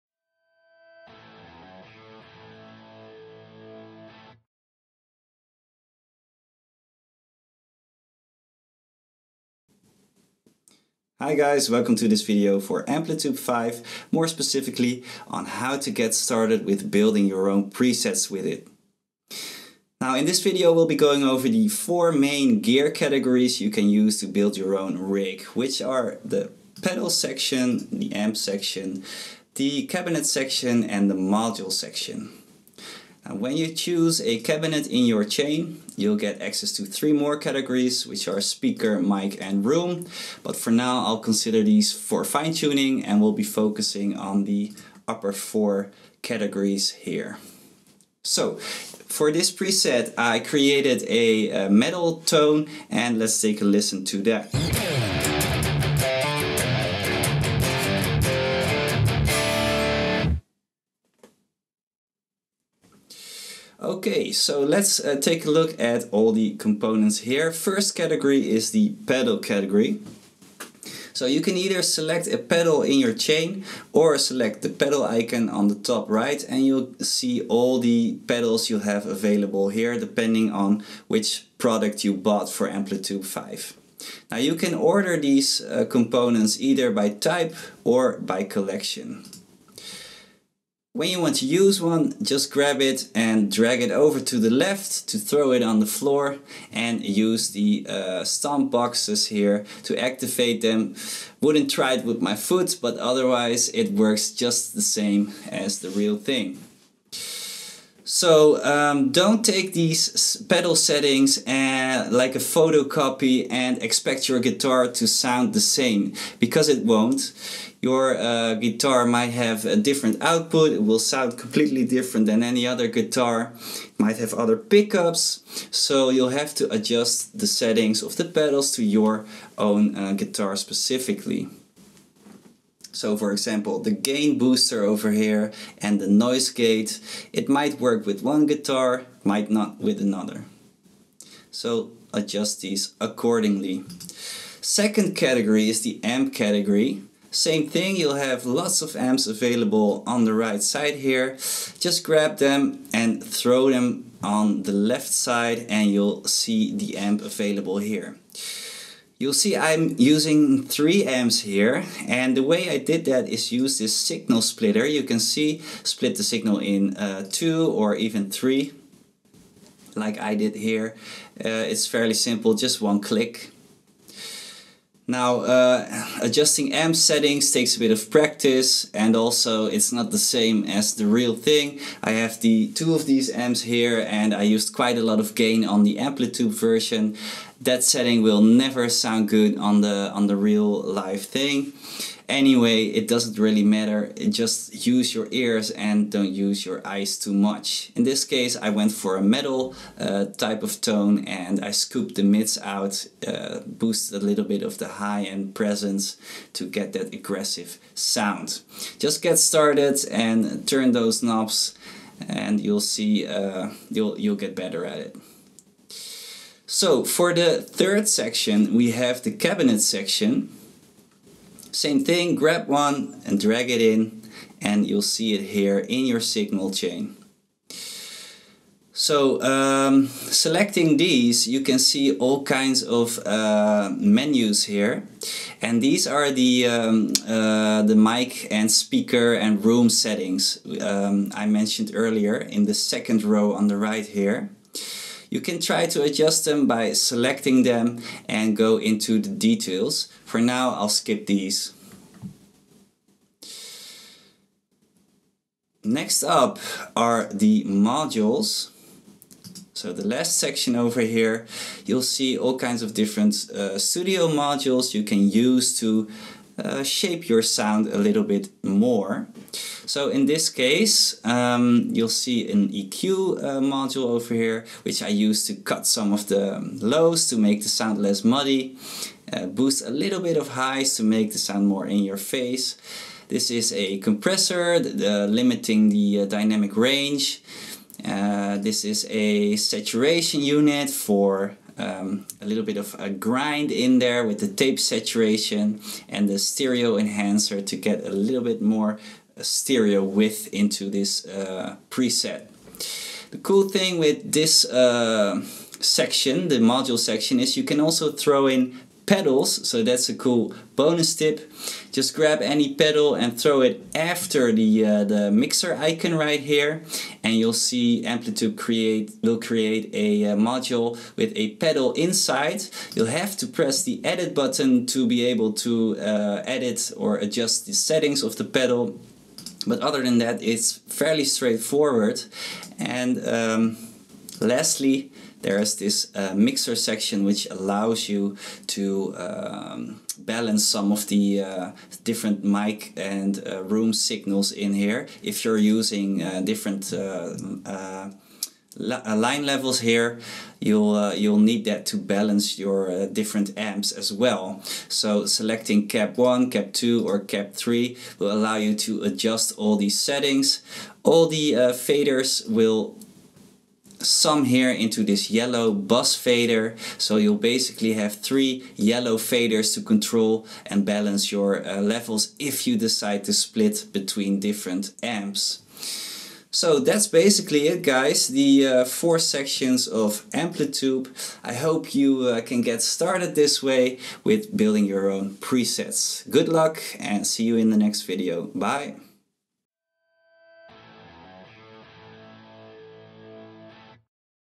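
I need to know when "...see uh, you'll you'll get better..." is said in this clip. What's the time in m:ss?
3:32.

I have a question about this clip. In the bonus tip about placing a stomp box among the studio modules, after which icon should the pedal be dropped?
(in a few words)
Mixer icon.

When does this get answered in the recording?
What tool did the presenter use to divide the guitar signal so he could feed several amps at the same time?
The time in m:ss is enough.
2:43.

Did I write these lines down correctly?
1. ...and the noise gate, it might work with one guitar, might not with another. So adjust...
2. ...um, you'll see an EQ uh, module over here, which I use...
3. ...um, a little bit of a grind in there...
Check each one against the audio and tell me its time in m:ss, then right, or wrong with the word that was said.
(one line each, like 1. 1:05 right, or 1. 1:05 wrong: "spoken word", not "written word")
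1. 2:15 right
2. 4:31 right
3. 4:51 right.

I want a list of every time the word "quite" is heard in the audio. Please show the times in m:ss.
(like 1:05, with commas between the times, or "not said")
3:04.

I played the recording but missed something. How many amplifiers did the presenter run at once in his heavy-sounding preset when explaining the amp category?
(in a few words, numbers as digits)
3.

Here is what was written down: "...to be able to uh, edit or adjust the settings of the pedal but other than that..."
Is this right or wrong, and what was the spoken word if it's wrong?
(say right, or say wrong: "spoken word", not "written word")
right.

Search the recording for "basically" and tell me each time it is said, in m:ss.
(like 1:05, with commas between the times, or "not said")
6:07, 6:17.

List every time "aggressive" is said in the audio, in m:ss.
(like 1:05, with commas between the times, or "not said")
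3:27.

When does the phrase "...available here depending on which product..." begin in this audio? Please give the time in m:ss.
1:19.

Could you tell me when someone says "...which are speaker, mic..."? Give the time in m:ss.
0:38.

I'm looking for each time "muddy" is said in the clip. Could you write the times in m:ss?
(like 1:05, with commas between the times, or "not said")
4:38.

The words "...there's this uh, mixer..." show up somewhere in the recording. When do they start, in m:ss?
5:35.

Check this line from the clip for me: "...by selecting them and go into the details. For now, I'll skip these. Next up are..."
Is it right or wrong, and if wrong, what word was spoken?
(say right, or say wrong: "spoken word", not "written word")
right.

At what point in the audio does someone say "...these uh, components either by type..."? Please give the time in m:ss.
1:25.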